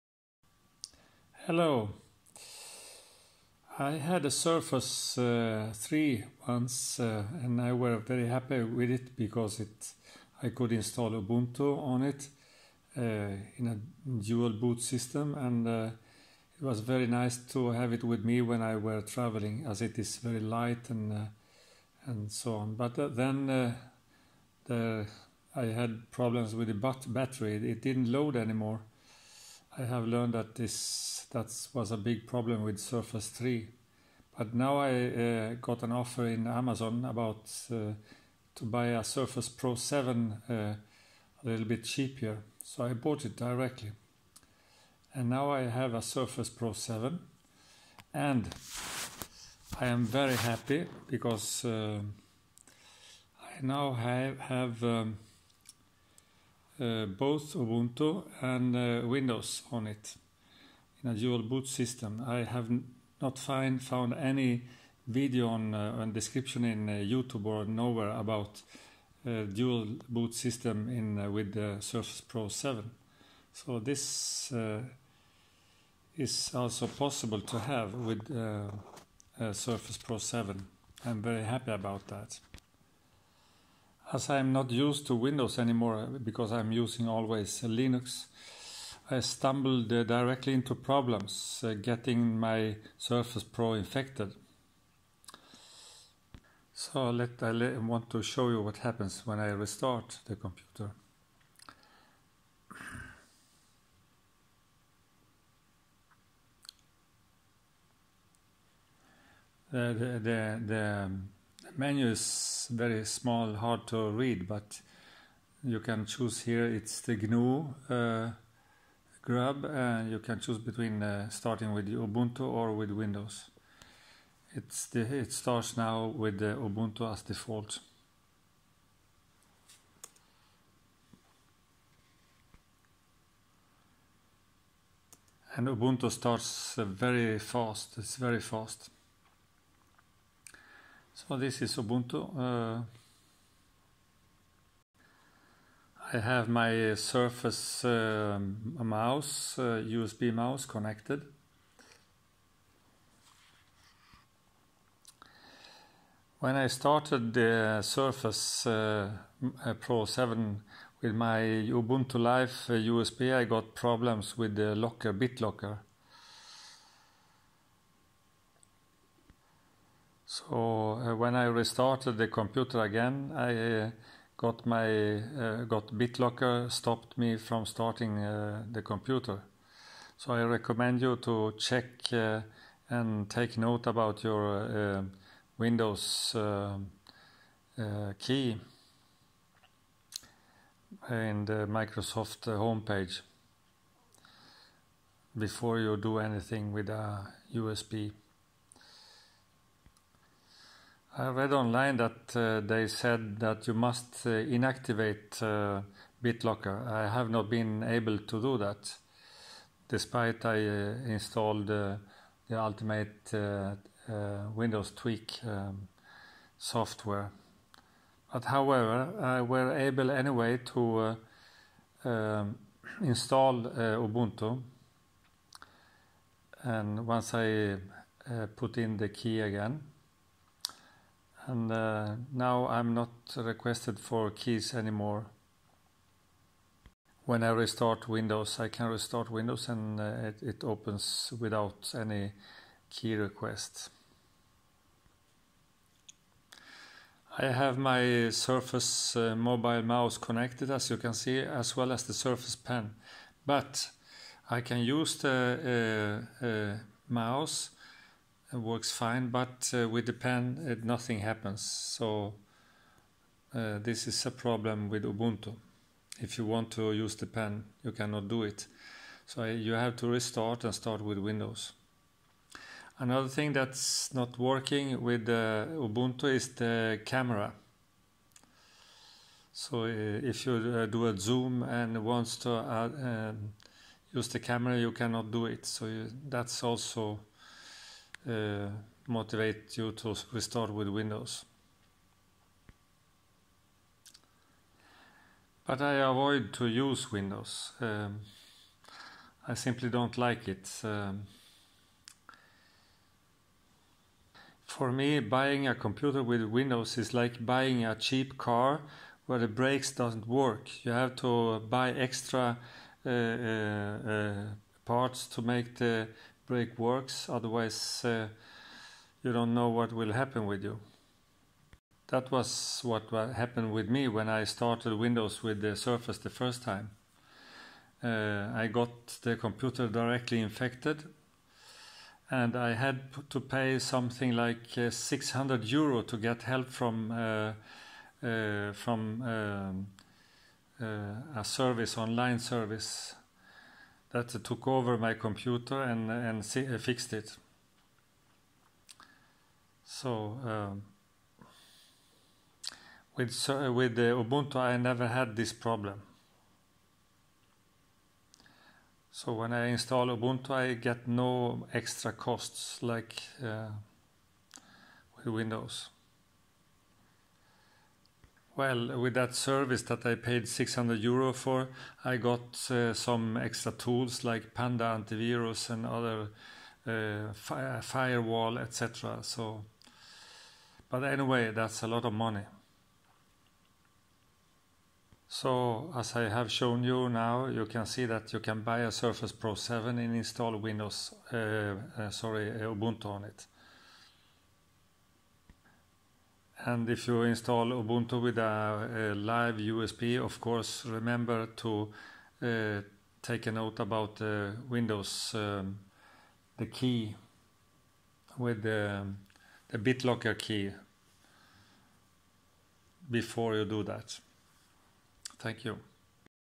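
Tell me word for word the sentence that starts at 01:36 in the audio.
So let, I want to show you what happens when I restart the computer.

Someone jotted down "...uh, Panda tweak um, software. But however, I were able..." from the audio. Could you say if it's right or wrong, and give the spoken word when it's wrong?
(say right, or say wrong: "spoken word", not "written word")
wrong: "Windows", not "Panda".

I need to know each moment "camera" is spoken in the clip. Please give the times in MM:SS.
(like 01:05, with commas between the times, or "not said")
04:37, 04:44.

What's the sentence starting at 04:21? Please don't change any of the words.
So uh, this is a problem with Ubuntu.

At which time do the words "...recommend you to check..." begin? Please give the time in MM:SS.
03:00.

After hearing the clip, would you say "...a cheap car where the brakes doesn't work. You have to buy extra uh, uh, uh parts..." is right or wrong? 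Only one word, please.
right.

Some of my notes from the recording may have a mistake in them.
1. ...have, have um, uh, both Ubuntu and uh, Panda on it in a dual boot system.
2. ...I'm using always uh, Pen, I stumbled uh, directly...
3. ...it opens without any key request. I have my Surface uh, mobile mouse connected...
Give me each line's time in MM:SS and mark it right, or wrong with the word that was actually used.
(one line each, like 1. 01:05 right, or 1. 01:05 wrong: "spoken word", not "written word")
1. 00:53 wrong: "Windows", not "Panda"
2. 01:26 wrong: "Linux", not "Pen"
3. 04:00 right.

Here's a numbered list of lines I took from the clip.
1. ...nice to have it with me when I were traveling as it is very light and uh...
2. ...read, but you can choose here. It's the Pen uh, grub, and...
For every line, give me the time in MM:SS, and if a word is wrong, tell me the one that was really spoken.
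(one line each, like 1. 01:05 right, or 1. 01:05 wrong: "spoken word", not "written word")
1. 00:17 right
2. 01:54 wrong: "GNU", not "Pen".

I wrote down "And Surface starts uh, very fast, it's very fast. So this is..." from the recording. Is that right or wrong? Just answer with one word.
wrong.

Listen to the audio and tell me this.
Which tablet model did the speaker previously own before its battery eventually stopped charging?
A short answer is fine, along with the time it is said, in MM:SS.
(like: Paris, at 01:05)
Surface 3, at 00:04.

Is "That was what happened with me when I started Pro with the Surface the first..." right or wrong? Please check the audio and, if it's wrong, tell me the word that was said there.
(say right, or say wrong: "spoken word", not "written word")
wrong: "Windows", not "Pro".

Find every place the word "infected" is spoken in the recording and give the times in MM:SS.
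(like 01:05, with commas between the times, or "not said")
01:33, 05:30.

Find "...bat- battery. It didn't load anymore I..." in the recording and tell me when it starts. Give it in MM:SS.
00:26.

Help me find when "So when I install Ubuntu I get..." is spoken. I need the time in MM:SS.
05:59.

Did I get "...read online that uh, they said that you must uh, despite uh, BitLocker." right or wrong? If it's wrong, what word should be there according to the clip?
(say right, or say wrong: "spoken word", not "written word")
wrong: "inactivate", not "despite".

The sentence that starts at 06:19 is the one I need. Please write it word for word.
So, but anyway, that's a lot of money.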